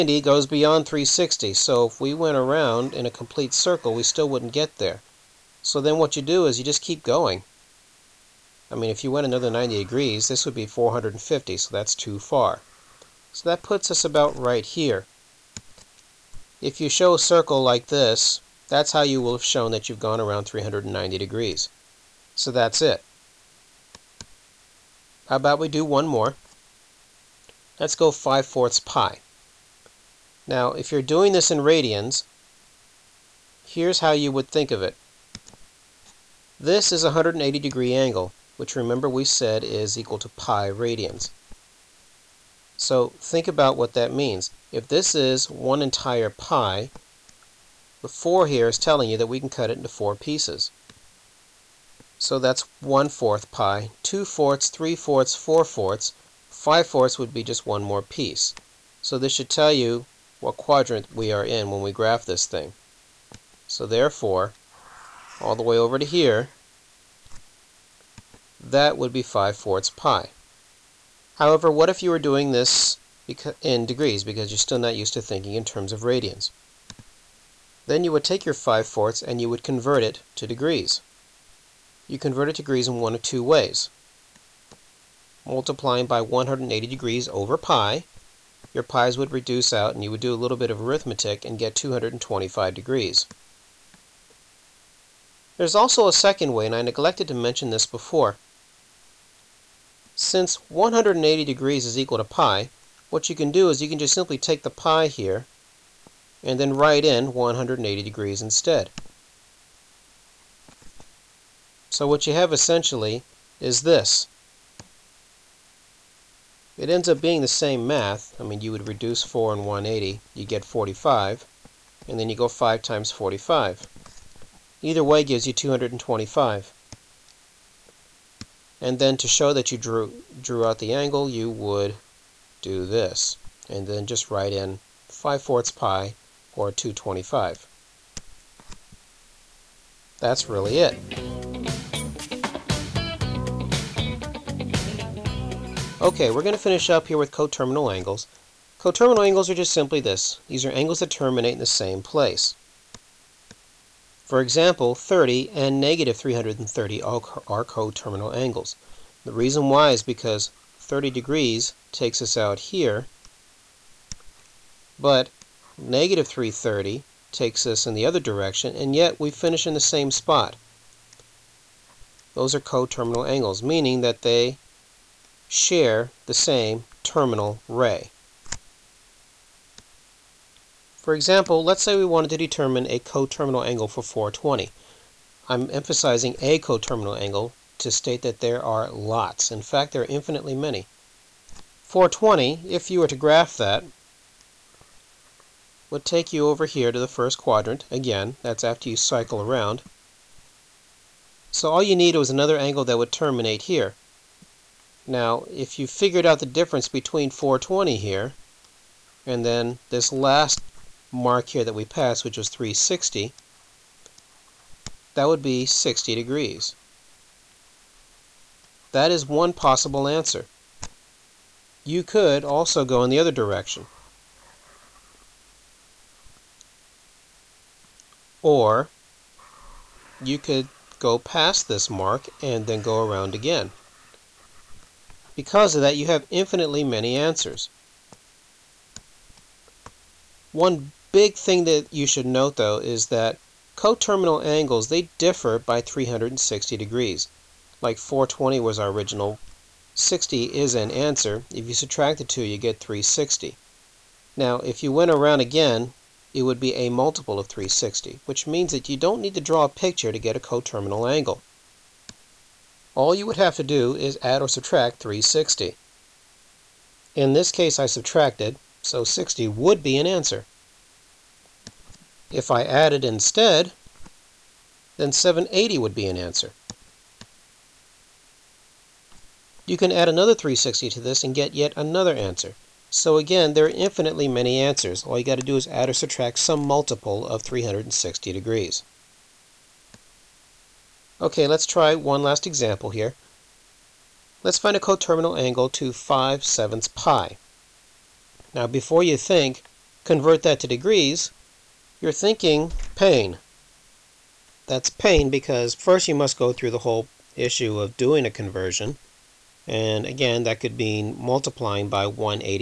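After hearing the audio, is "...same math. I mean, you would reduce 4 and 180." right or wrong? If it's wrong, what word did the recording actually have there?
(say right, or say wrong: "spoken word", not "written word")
right.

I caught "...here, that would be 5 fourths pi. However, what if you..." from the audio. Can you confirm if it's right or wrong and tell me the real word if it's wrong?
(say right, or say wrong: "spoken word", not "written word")
right.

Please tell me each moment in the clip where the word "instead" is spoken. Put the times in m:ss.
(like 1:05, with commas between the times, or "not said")
1:48, 4:33.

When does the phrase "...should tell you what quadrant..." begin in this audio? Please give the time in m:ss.
0:59.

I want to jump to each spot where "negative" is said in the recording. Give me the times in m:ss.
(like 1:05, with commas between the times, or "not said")
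2:35, 2:45.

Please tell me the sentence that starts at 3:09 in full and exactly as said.
In fact, there are infinitely many.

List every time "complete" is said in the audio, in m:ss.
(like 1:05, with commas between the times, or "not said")
0:03.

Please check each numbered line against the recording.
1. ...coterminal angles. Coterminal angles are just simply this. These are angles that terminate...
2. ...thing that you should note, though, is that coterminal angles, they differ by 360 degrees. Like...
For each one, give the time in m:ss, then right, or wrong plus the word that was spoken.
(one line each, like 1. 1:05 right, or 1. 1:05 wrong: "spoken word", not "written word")
1. 2:27 right
2. 4:01 right.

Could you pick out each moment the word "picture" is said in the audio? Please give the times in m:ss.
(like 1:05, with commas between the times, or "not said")
4:19.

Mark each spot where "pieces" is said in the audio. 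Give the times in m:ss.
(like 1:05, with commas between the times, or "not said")
0:50, 0:58.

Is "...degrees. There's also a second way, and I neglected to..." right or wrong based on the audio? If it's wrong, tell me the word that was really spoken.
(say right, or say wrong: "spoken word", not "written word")
right.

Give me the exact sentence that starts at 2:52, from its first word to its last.
Those are coterminal angles, meaning that they share the same terminal ray.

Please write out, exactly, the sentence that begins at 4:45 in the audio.
All you got to do is add or subtract some multiple of 360 degrees.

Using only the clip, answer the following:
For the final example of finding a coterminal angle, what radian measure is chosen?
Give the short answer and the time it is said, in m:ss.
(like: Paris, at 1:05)
5/7 pi, at 4:55.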